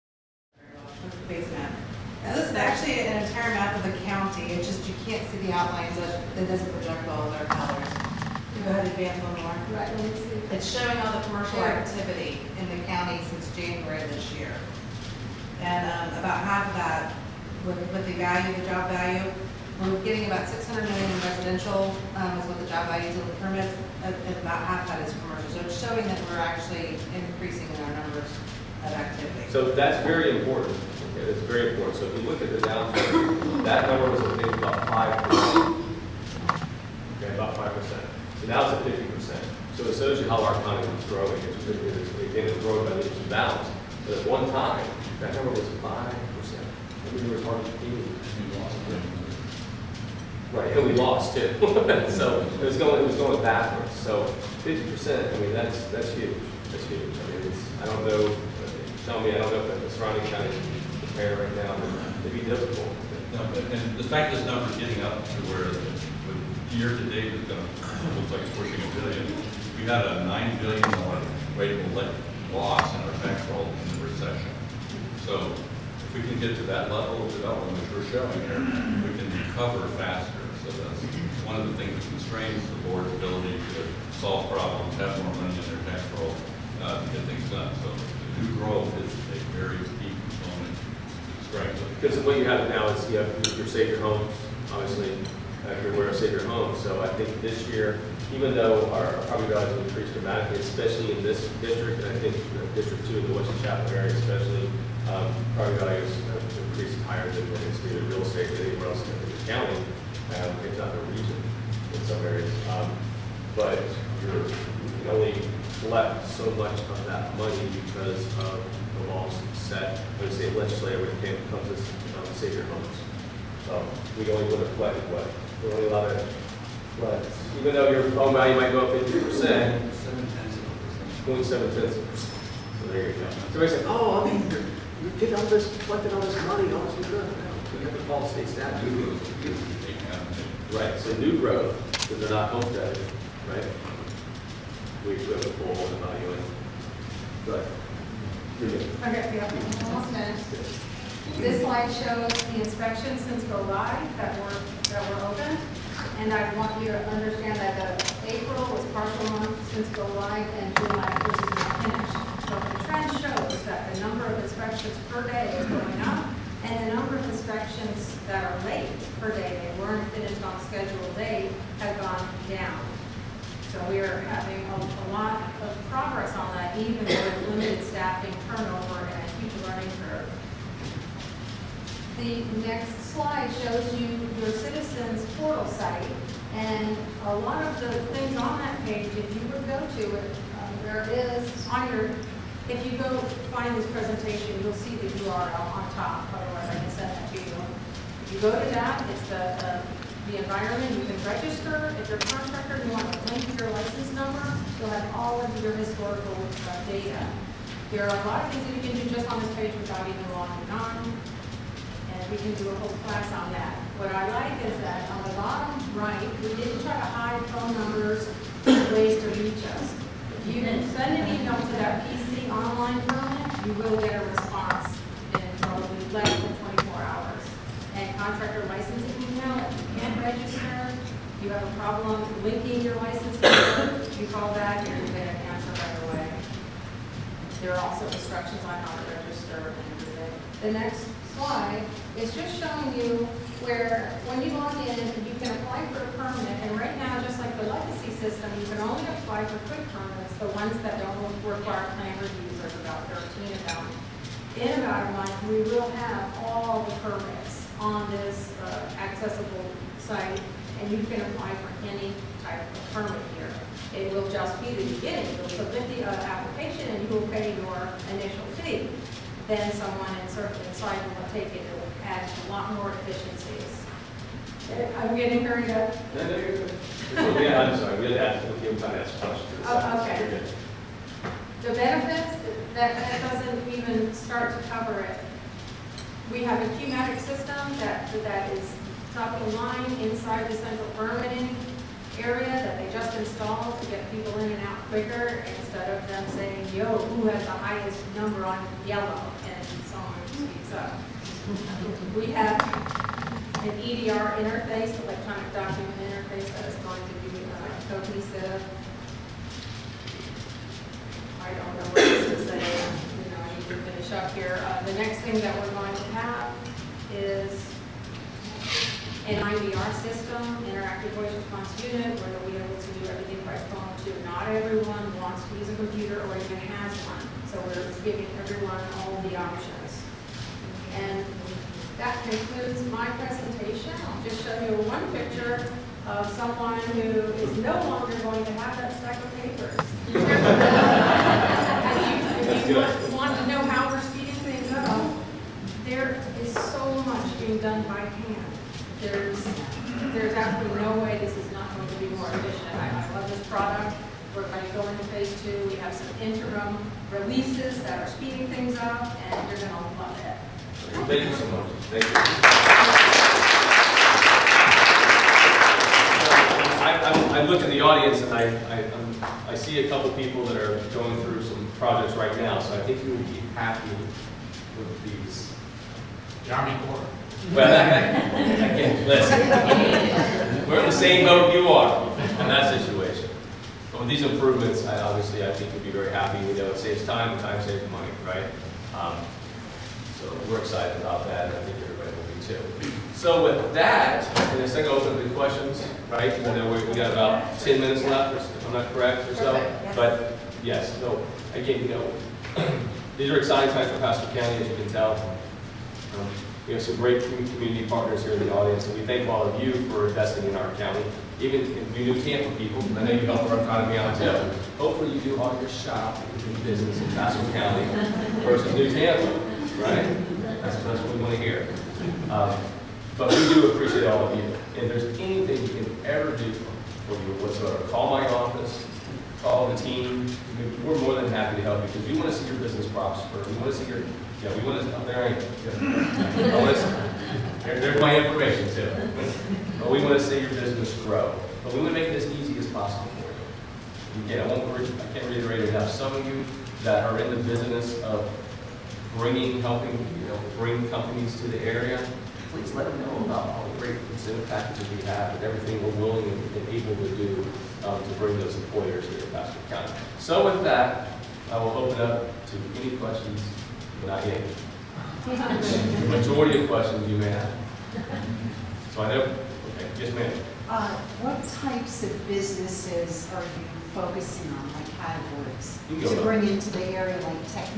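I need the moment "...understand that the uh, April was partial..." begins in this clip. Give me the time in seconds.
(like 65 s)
157 s.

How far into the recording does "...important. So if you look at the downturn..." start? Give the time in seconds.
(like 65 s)
31 s.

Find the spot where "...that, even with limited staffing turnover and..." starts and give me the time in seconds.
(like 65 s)
176 s.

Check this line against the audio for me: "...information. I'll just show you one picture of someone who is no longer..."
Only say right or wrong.
wrong.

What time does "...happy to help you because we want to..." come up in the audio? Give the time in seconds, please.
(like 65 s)
431 s.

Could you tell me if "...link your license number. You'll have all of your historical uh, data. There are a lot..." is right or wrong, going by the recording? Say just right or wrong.
right.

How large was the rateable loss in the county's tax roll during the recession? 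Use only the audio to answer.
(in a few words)
9 billion dollars.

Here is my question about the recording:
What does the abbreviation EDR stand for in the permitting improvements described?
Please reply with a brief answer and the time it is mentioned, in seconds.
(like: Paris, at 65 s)
electronic document interface, at 305 s.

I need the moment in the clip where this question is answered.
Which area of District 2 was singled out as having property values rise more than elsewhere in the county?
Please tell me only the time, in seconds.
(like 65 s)
103 s.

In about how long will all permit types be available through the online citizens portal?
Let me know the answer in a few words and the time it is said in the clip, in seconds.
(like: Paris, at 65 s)
a month, at 254 s.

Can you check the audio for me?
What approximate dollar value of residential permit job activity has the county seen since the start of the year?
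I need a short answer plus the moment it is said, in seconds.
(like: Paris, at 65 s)
600 million, at 20 s.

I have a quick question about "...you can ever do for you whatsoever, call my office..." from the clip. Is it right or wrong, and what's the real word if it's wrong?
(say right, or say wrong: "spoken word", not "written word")
right.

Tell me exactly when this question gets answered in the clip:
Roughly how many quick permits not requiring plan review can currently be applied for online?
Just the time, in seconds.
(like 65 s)
253 s.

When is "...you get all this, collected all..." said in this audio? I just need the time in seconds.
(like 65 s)
135 s.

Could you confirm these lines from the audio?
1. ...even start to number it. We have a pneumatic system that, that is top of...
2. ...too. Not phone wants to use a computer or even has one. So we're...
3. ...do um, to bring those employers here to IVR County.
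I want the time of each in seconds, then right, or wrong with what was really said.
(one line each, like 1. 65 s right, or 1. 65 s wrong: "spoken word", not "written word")
1. 283 s wrong: "cover", not "number"
2. 324 s wrong: "everyone", not "phone"
3. 457 s wrong: "Pasco", not "IVR".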